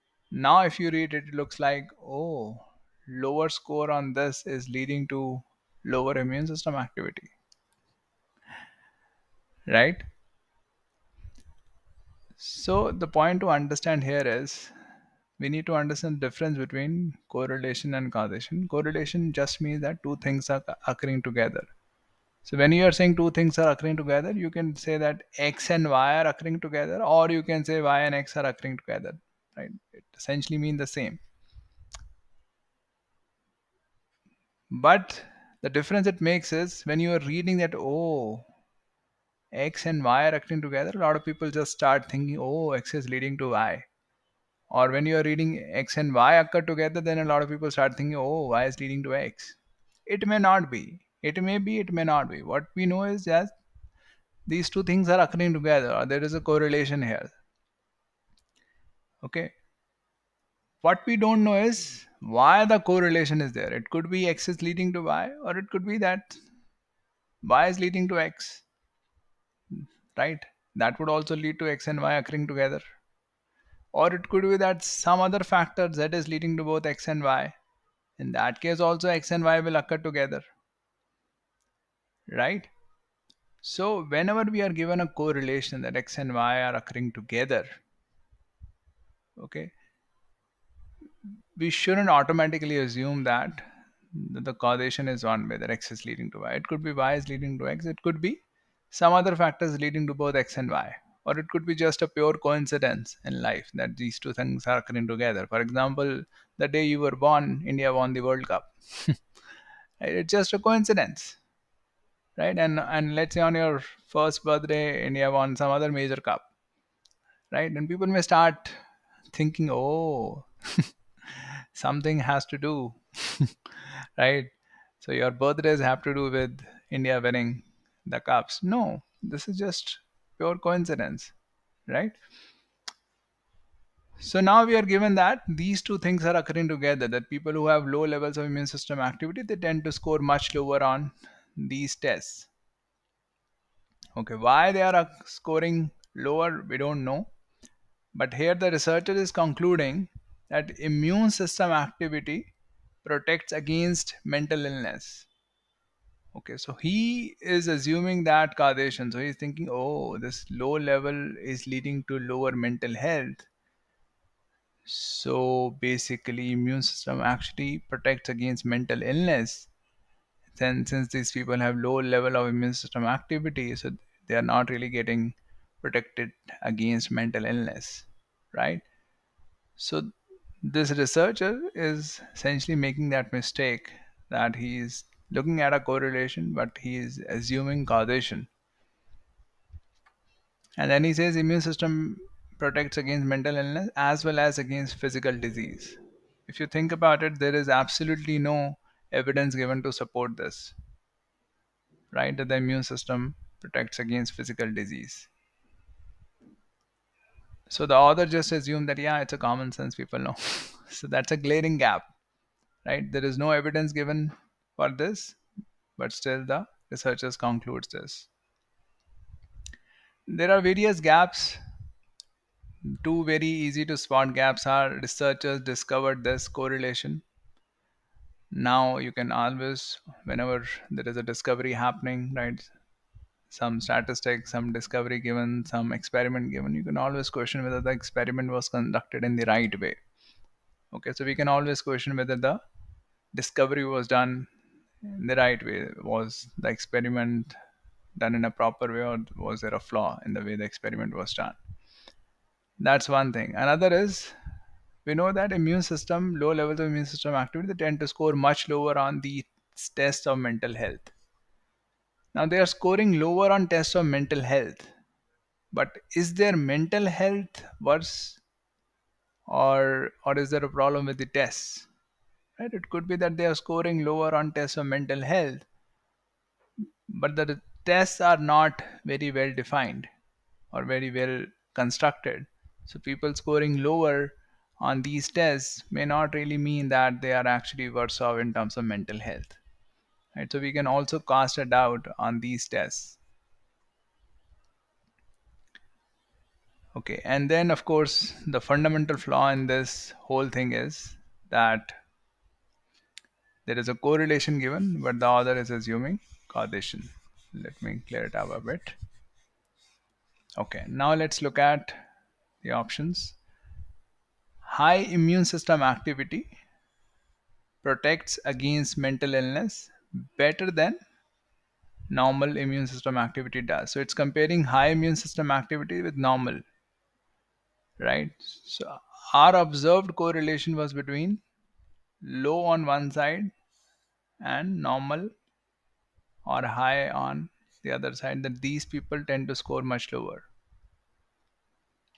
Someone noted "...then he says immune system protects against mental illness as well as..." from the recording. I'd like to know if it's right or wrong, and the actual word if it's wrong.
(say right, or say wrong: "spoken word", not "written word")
right.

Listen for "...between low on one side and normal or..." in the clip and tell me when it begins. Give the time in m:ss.
5:30.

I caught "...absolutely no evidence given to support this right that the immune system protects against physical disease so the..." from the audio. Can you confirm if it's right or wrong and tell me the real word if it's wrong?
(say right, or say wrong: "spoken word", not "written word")
right.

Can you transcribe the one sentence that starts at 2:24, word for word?
Okay, why they are uh, scoring lower we don't know.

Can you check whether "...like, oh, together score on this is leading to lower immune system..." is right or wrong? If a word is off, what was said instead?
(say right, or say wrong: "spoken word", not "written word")
wrong: "lower", not "together".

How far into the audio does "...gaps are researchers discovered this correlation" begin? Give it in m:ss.
3:44.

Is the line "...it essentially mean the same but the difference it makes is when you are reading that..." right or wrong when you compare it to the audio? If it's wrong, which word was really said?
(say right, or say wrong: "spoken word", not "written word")
right.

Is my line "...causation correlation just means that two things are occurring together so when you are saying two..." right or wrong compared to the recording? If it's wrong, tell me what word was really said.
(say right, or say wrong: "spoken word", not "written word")
right.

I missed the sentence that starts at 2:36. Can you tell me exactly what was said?
Okay, so he is assuming that causation.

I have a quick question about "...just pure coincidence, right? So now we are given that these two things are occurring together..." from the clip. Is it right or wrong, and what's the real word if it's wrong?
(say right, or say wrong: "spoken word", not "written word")
right.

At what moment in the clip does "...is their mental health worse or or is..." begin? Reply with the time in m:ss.
4:26.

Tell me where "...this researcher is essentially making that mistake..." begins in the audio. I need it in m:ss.
3:00.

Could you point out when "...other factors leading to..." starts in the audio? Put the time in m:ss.
1:39.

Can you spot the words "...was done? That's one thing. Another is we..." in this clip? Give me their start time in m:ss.
4:11.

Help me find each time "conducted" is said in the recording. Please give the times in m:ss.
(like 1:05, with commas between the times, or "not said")
3:58.